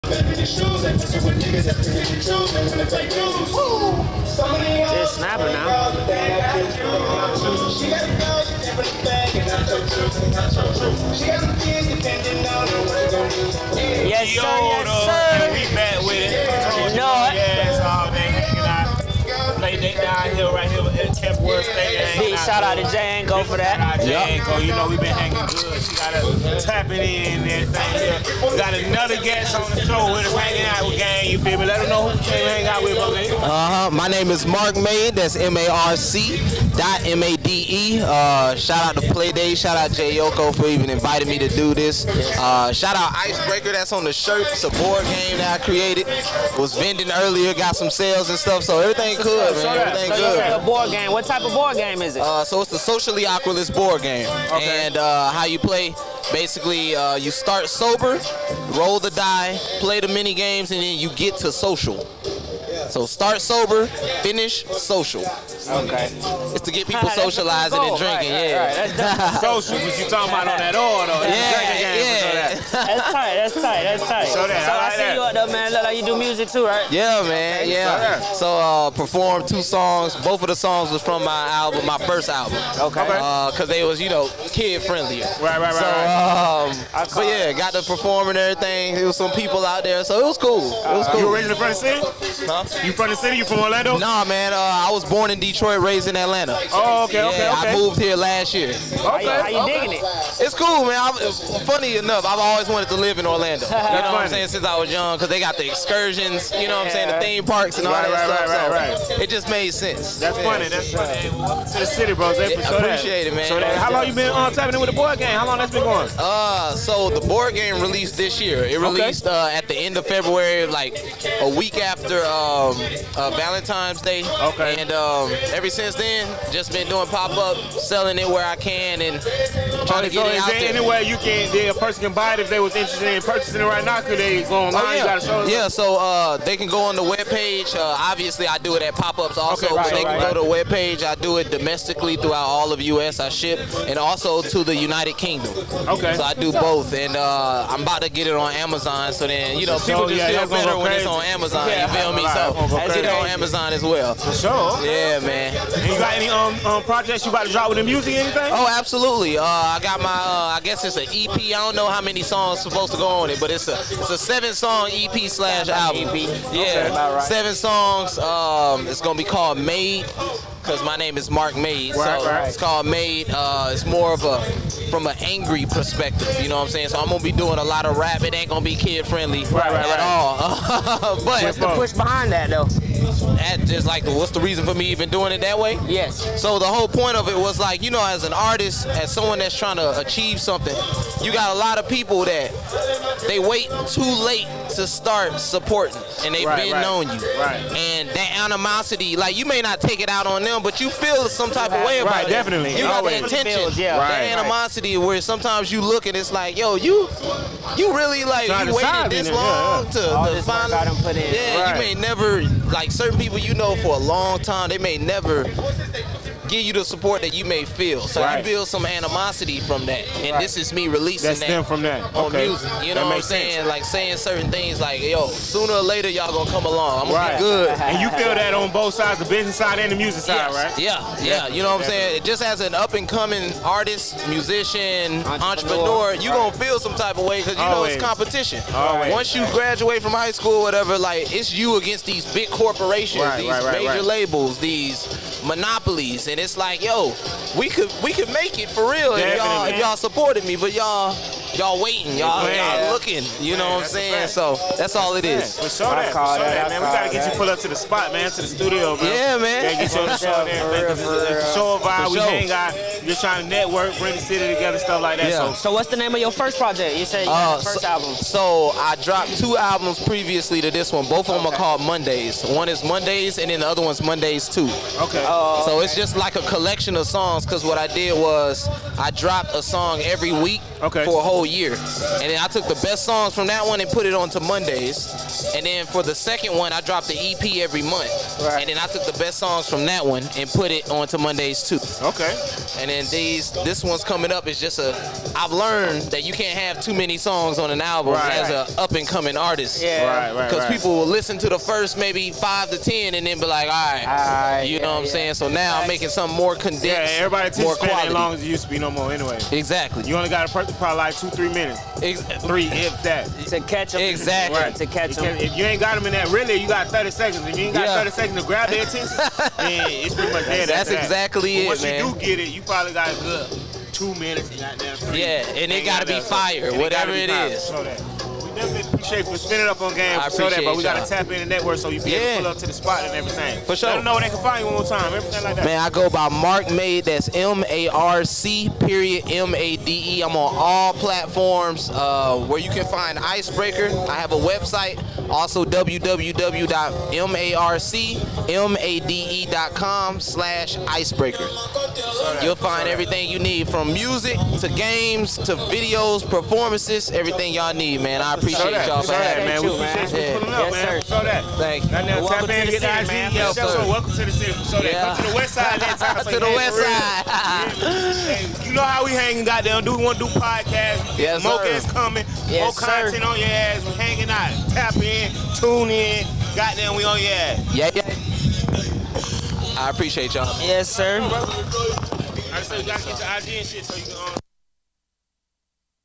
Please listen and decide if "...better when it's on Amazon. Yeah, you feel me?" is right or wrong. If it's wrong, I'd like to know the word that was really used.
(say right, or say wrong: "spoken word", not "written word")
right.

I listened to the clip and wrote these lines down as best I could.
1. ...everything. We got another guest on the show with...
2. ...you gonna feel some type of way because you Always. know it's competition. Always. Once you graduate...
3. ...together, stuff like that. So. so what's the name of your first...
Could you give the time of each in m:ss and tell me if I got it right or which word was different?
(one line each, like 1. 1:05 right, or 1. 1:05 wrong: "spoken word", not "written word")
1. 0:27 right
2. 3:56 right
3. 4:24 right.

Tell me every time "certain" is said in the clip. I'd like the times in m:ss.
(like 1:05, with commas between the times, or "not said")
3:32, 3:44.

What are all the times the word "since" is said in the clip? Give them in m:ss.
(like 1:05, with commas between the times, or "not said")
1:44, 2:05.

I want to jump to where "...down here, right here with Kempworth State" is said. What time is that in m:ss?
0:19.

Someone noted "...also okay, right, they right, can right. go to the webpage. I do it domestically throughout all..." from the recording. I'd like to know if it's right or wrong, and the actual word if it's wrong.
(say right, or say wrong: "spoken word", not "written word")
right.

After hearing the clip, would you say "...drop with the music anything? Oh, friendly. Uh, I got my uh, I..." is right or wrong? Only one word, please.
wrong.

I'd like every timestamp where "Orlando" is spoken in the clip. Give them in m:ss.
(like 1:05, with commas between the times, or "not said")
1:33, 1:43.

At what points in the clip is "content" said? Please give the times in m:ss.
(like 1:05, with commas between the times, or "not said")
6:12.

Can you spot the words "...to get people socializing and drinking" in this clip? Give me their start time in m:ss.
1:06.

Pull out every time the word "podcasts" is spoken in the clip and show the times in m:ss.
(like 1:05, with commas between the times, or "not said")
6:10.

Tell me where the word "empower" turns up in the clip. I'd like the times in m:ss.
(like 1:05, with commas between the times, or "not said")
not said.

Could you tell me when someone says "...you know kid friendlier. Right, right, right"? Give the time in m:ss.
1:24.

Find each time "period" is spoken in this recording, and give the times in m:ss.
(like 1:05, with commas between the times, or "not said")
5:38.